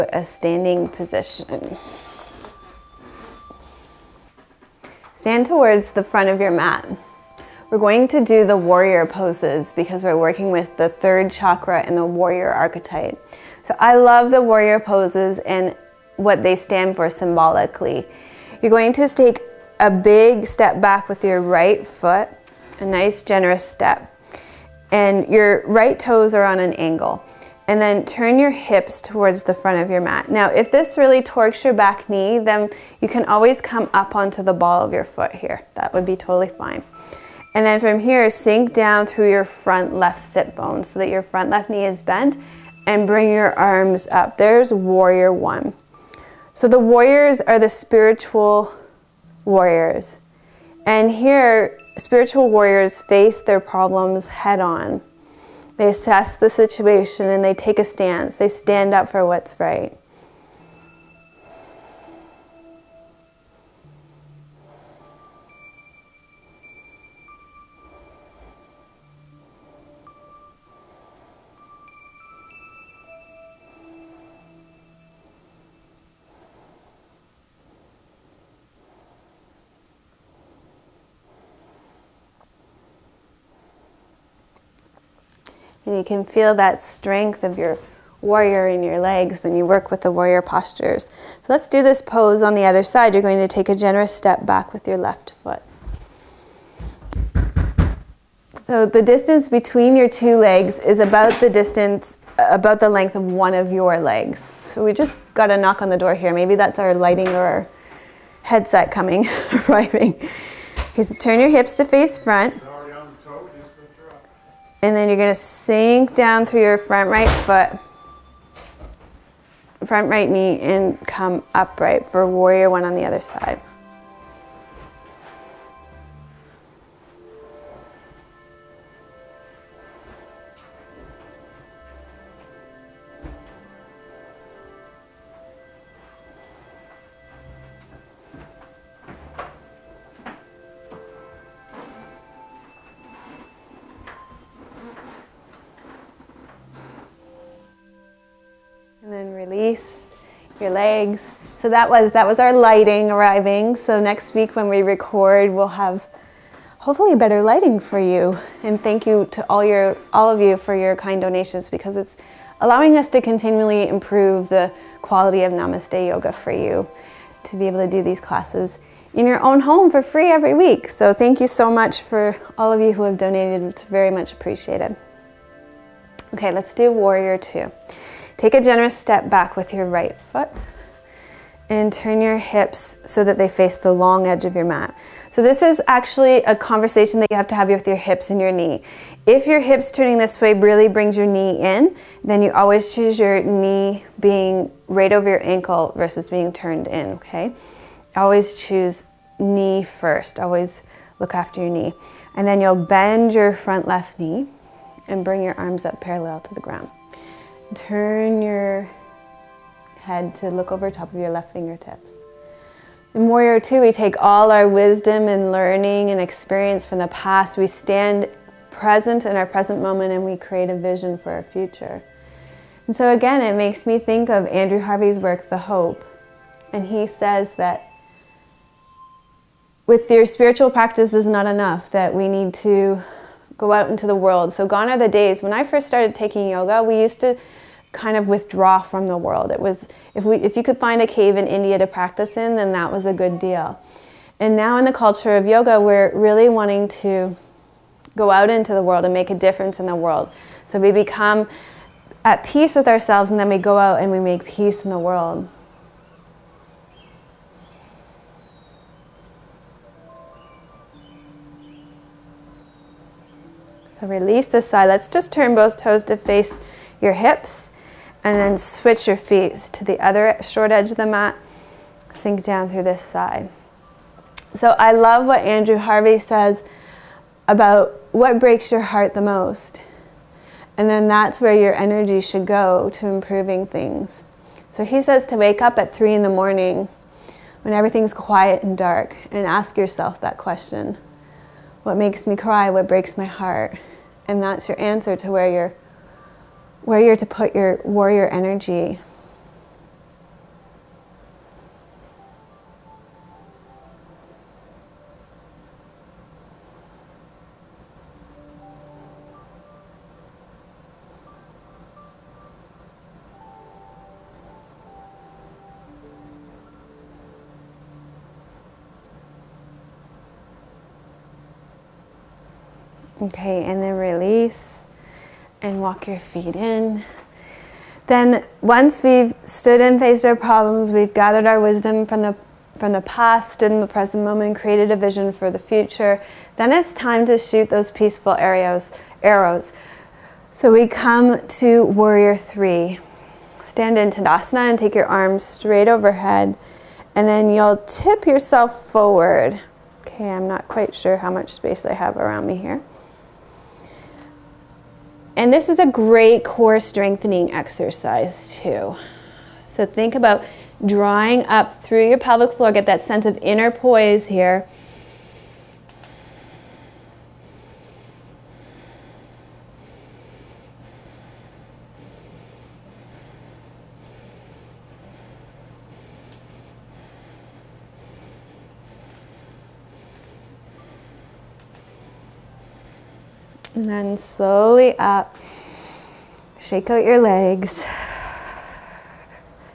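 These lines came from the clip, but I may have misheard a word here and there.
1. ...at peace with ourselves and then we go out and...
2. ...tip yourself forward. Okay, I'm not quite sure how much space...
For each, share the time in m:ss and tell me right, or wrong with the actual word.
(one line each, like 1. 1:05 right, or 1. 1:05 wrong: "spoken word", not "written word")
1. 4:12 right
2. 5:47 right.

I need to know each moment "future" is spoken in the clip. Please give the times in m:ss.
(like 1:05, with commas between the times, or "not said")
3:41, 5:35.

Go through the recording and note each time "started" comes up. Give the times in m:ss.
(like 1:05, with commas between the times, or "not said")
3:55.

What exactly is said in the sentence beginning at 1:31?
So let's do this pose on the other side.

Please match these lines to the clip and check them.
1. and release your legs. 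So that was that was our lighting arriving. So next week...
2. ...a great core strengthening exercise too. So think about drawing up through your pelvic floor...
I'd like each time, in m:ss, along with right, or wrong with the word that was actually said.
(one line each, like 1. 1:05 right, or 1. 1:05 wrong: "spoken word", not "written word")
1. 2:29 right
2. 5:55 right.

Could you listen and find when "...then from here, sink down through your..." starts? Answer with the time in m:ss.
0:37.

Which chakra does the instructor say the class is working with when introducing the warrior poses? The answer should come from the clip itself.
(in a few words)
Third chakra.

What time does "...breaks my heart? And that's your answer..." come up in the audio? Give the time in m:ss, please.
4:52.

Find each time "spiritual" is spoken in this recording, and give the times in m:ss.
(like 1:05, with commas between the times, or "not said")
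0:47, 0:52, 3:50.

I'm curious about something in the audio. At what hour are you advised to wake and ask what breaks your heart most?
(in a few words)
3 a.m.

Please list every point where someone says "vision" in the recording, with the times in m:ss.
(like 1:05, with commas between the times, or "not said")
3:40, 5:34.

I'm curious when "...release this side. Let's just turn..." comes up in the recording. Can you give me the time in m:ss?
4:24.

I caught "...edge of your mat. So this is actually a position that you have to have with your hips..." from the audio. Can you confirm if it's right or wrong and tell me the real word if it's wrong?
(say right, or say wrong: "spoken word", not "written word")
wrong: "conversation", not "position".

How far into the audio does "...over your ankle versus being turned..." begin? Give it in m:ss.
3:15.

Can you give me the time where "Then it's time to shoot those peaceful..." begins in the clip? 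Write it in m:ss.
5:36.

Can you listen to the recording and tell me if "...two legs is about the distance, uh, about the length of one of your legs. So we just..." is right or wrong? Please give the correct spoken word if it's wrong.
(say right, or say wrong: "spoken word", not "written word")
right.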